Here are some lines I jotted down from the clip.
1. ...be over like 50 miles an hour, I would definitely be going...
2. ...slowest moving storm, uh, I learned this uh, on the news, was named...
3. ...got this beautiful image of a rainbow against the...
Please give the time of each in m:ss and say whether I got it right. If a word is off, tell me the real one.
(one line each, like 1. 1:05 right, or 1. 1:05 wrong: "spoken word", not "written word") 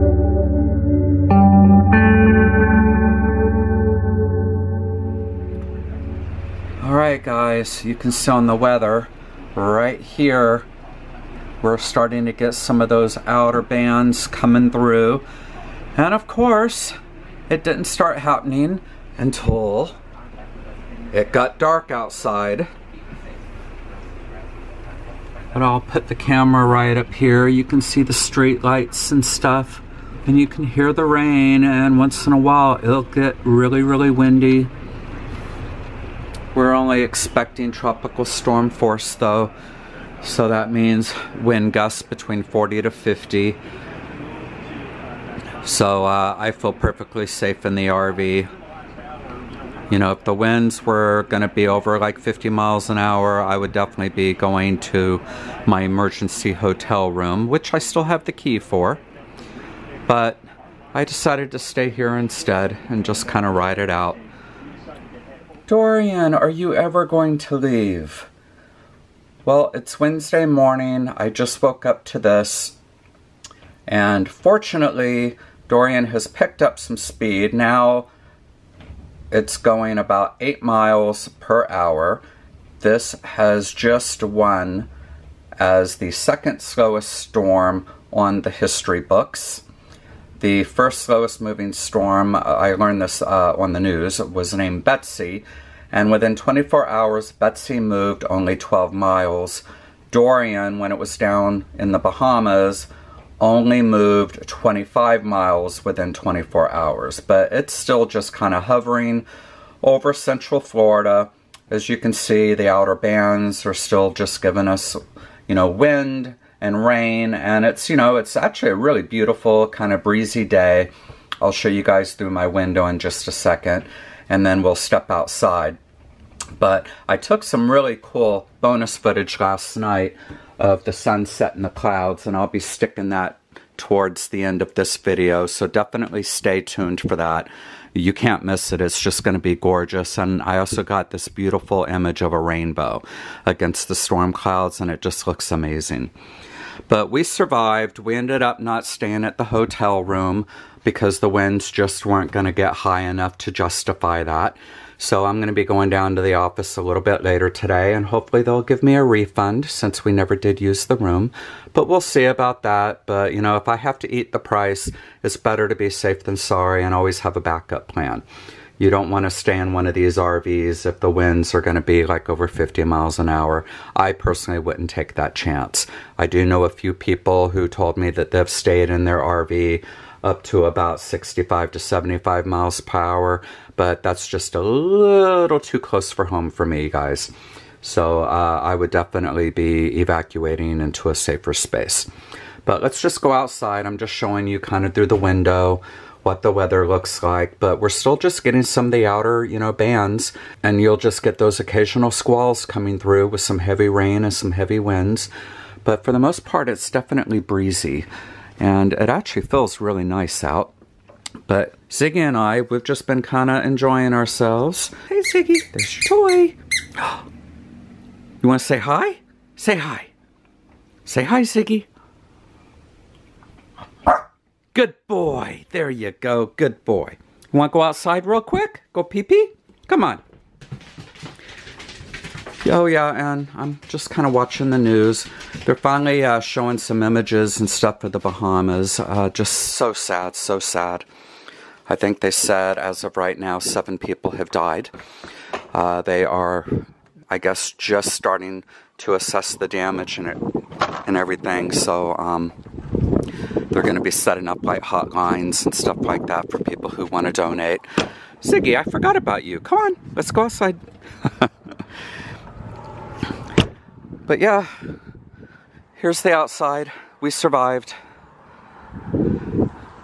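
1. 0:51 right
2. 1:31 right
3. 2:20 right.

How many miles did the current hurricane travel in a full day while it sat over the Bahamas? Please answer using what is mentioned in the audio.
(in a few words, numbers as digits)
25.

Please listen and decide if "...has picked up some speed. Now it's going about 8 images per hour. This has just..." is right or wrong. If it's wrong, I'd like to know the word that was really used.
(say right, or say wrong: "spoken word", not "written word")
wrong: "miles", not "images".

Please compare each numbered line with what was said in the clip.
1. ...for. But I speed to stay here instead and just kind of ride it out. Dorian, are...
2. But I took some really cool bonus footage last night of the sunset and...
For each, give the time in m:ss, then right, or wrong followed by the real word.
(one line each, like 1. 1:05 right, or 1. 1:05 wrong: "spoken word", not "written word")
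1. 0:58 wrong: "decided", not "speed"
2. 2:06 right.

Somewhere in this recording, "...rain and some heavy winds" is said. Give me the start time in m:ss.
3:23.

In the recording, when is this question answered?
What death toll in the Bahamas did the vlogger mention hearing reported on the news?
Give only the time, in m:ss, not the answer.
4:03.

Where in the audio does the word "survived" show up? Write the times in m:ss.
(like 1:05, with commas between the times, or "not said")
2:27, 4:27.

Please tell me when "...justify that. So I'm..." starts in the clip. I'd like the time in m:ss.
2:33.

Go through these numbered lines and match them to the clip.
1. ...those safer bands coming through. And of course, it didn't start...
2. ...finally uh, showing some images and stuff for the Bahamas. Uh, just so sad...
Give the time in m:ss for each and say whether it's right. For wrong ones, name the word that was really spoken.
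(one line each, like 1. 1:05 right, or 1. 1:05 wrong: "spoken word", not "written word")
1. 0:12 wrong: "outer", not "safer"
2. 3:55 right.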